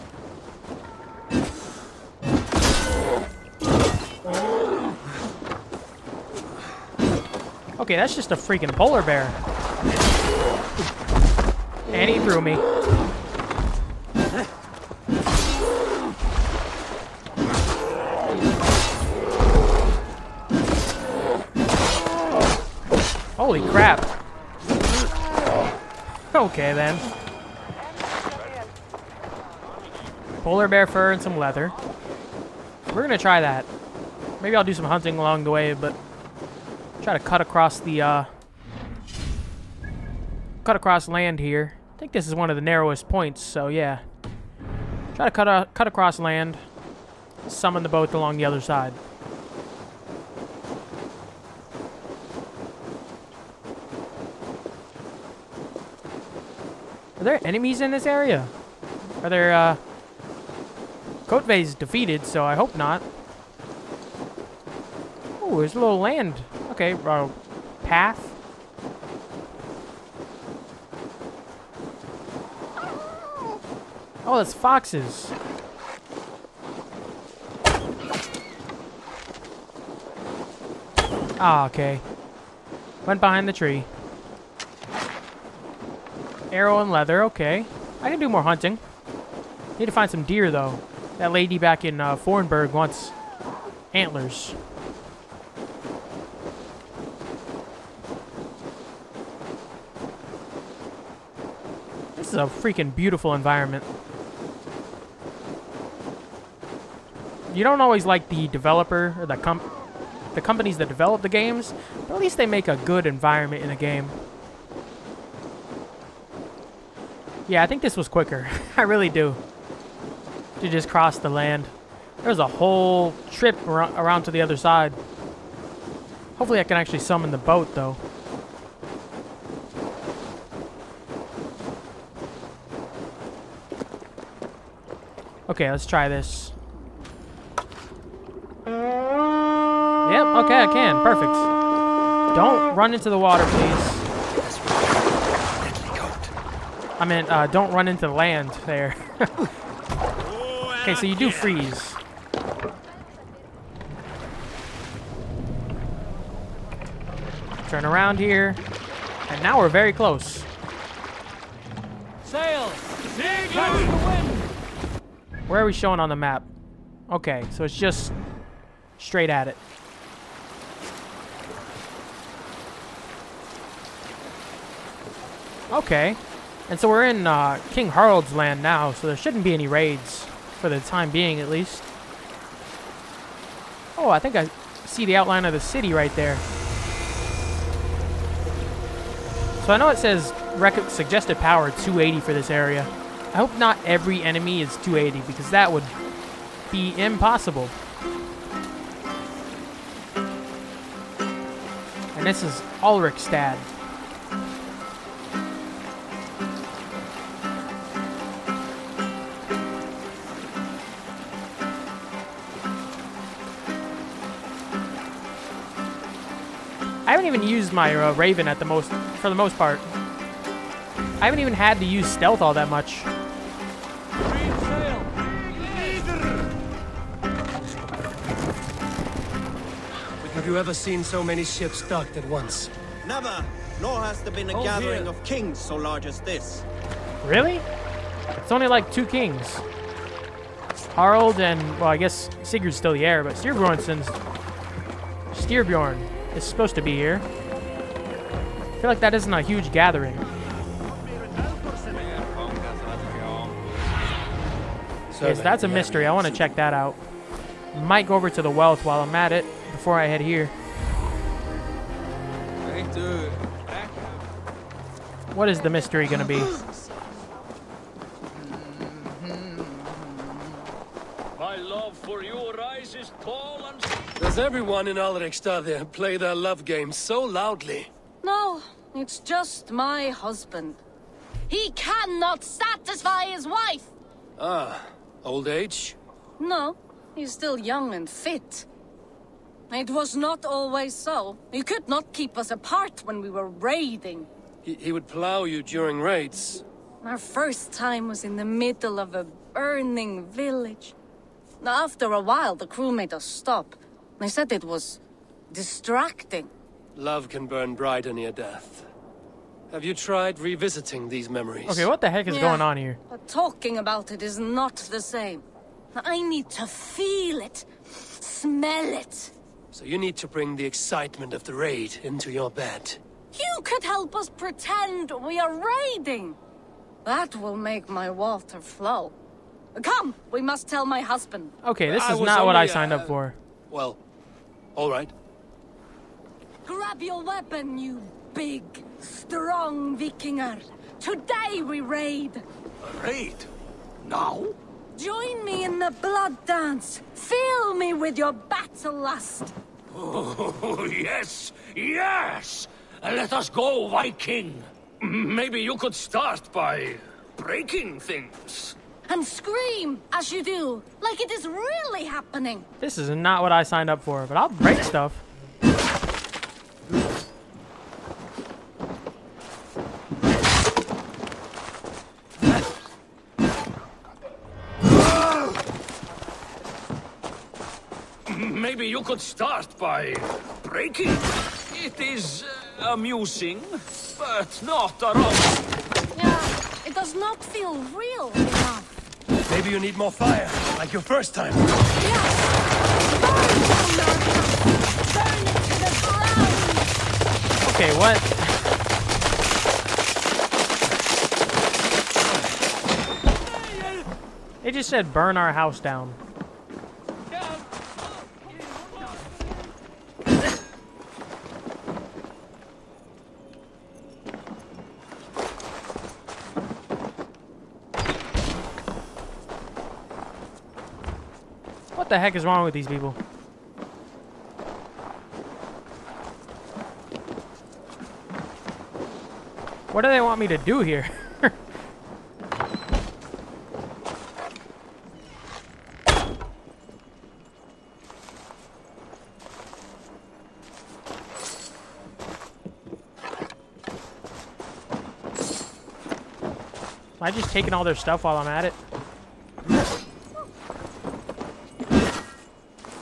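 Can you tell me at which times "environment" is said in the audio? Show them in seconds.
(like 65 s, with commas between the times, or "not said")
103 s, 113 s.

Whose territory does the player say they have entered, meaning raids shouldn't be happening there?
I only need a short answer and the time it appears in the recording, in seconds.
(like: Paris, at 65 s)
King Harald, at 177 s.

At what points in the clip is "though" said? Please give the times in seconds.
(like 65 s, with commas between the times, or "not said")
90 s, 127 s.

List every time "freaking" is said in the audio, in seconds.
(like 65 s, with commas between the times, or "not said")
8 s, 102 s.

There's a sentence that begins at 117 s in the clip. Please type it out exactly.
Yeah, I think this was quicker.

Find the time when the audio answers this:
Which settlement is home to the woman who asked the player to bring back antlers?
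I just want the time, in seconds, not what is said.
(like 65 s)
92 s.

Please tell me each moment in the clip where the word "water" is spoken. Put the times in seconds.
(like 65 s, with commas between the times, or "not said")
143 s, 328 s.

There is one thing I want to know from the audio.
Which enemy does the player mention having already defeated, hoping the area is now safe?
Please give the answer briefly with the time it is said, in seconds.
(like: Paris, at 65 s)
Kjotve, at 61 s.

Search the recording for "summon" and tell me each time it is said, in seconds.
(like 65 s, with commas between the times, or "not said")
47 s, 126 s.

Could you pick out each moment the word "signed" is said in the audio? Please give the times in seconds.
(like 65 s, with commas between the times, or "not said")
332 s, 363 s.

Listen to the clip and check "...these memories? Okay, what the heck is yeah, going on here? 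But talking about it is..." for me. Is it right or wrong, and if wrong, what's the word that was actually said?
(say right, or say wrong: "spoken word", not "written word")
right.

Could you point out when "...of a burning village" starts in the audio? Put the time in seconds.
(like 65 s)
298 s.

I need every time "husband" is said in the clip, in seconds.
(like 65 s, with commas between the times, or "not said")
280 s, 331 s.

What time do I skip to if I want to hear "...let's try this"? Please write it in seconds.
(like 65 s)
135 s.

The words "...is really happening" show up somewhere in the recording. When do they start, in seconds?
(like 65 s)
361 s.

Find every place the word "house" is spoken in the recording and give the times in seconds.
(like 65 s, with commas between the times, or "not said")
405 s.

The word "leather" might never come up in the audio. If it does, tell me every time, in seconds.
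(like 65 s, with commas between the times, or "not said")
31 s, 86 s.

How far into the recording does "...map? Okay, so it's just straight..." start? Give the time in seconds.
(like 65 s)
166 s.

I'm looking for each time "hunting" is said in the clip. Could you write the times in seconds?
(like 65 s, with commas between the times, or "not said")
34 s, 88 s.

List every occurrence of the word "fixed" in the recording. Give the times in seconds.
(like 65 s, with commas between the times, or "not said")
not said.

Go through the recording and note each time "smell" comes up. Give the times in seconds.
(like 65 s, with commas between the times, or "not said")
317 s.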